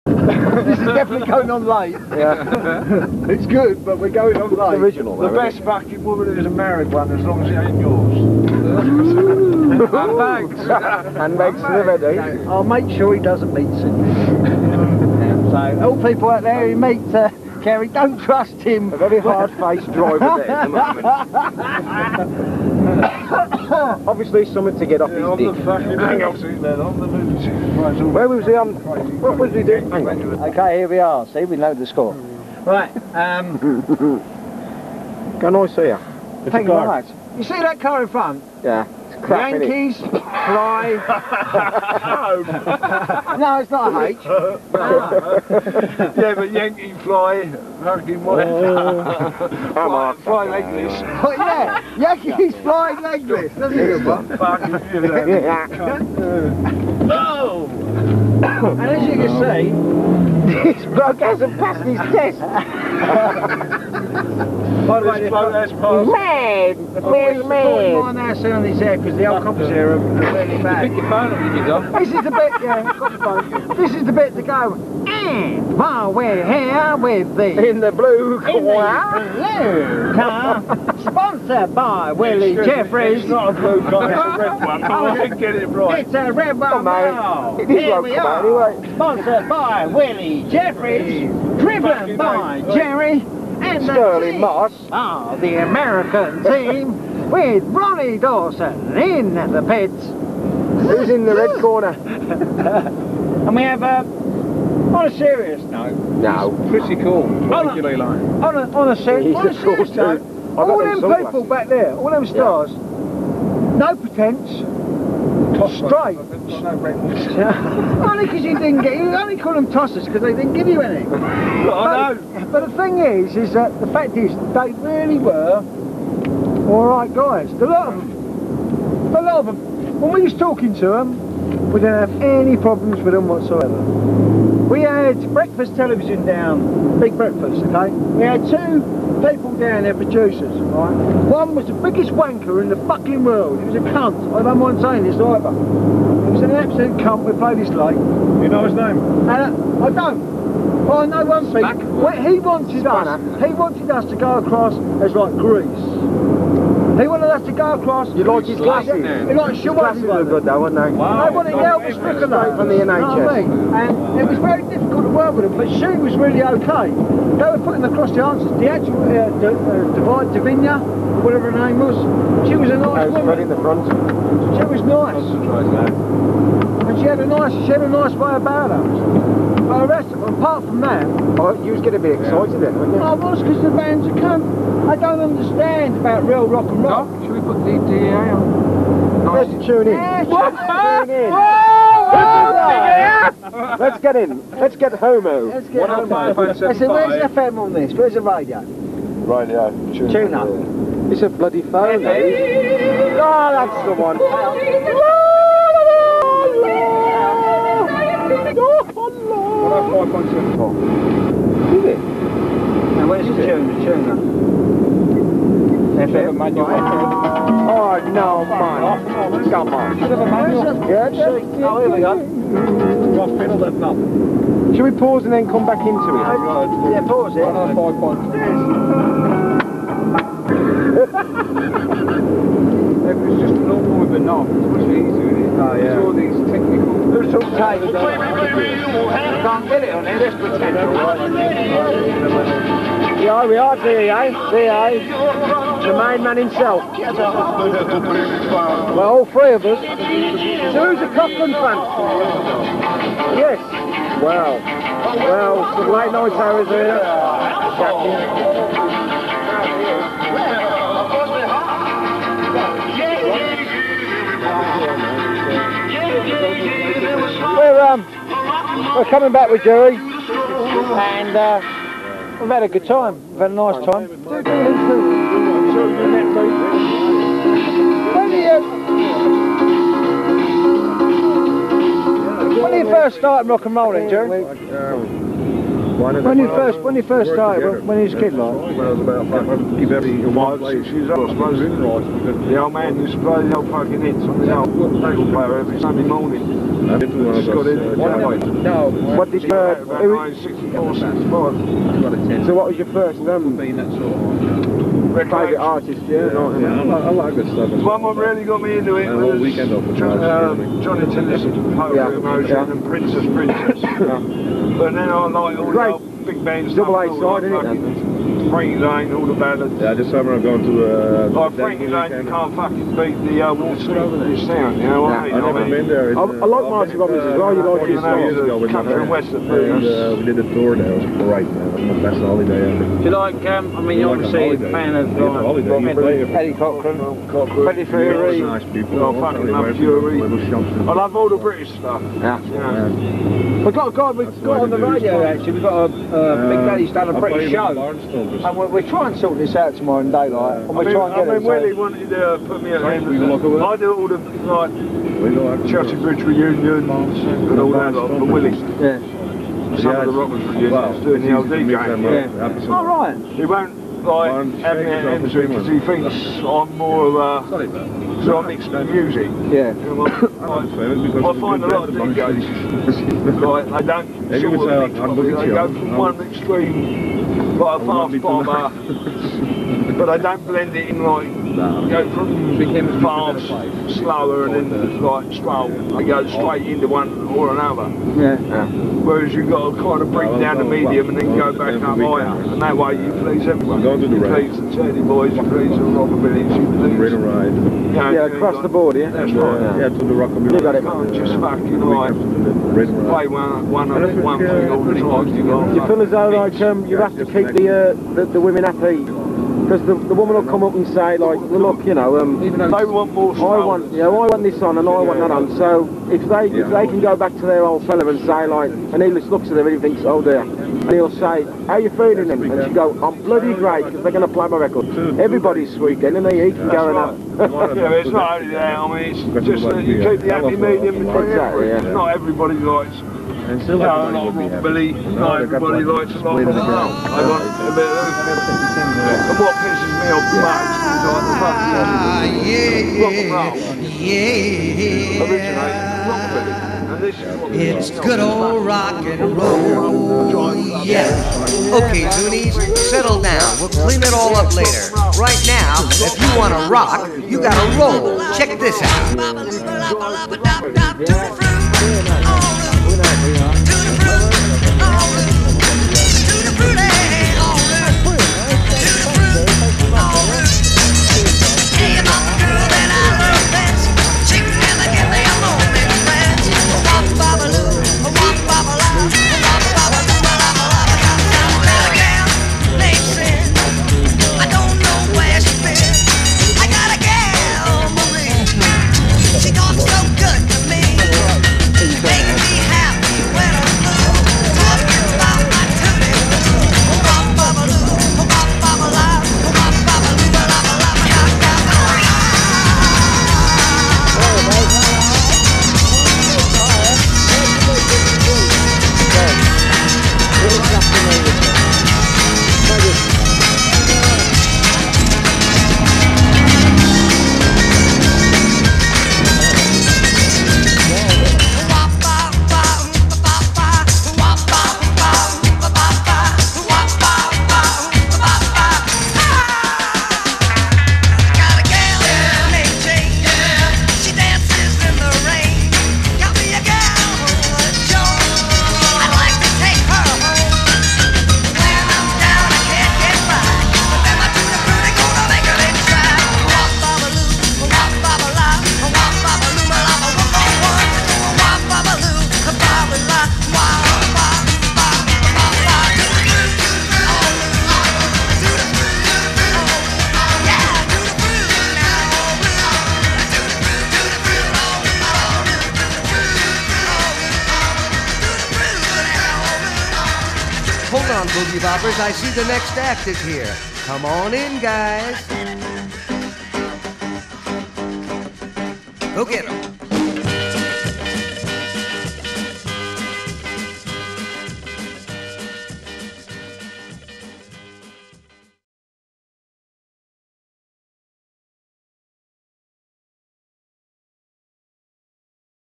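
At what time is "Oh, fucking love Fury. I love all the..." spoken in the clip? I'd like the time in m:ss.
5:38.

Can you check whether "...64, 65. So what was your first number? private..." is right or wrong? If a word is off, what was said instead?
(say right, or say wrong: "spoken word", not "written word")
right.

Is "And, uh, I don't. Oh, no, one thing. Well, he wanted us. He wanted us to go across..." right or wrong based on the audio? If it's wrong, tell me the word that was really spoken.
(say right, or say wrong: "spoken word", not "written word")
right.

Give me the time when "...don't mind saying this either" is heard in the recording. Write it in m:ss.
2:24.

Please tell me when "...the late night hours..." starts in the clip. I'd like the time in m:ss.
4:15.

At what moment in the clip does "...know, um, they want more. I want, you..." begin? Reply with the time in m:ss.
6:51.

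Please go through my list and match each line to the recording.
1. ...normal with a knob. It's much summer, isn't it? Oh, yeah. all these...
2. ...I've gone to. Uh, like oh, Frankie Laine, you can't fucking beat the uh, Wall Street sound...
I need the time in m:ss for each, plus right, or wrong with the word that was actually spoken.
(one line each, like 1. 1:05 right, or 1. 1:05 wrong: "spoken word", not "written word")
1. 3:53 wrong: "easier", not "summer"
2. 5:20 right.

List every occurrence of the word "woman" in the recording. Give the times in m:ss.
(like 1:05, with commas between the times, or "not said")
0:05, 2:53, 6:50.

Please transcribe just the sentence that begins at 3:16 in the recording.
Oh I said, where's the FM on this?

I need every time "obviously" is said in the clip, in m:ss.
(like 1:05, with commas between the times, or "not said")
0:24, 5:34.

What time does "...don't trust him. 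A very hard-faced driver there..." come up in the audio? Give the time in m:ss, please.
0:17.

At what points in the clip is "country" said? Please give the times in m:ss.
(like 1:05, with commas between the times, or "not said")
5:28.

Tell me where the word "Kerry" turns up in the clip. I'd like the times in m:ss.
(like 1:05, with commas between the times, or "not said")
0:17.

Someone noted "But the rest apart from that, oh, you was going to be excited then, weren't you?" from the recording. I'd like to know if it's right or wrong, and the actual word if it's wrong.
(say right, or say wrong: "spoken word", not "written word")
right.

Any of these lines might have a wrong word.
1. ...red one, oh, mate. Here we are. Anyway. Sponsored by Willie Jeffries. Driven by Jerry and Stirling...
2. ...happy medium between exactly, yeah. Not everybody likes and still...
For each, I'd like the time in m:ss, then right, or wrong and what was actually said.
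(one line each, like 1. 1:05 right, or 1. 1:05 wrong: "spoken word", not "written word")
1. 1:26 right
2. 7:10 right.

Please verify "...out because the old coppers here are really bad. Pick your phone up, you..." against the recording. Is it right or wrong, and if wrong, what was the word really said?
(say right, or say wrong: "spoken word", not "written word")
right.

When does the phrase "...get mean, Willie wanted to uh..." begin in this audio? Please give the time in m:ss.
5:51.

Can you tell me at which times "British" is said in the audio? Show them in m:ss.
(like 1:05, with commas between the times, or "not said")
5:41, 5:47.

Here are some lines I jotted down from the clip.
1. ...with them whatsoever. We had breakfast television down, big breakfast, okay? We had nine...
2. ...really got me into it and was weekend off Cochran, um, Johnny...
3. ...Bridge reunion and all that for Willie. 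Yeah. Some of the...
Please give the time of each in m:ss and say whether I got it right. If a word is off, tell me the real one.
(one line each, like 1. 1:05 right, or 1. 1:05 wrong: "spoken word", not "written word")
1. 2:13 wrong: "two", not "nine"
2. 5:08 wrong: "John", not "Cochran"
3. 5:55 right.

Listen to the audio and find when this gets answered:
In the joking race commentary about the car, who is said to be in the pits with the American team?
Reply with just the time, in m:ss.
1:37.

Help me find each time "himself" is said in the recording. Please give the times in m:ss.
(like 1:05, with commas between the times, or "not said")
4:06.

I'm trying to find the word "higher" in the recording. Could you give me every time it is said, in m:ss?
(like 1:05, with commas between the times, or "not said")
6:31.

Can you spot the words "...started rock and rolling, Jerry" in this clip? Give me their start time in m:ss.
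4:43.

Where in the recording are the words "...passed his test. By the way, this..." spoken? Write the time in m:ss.
1:01.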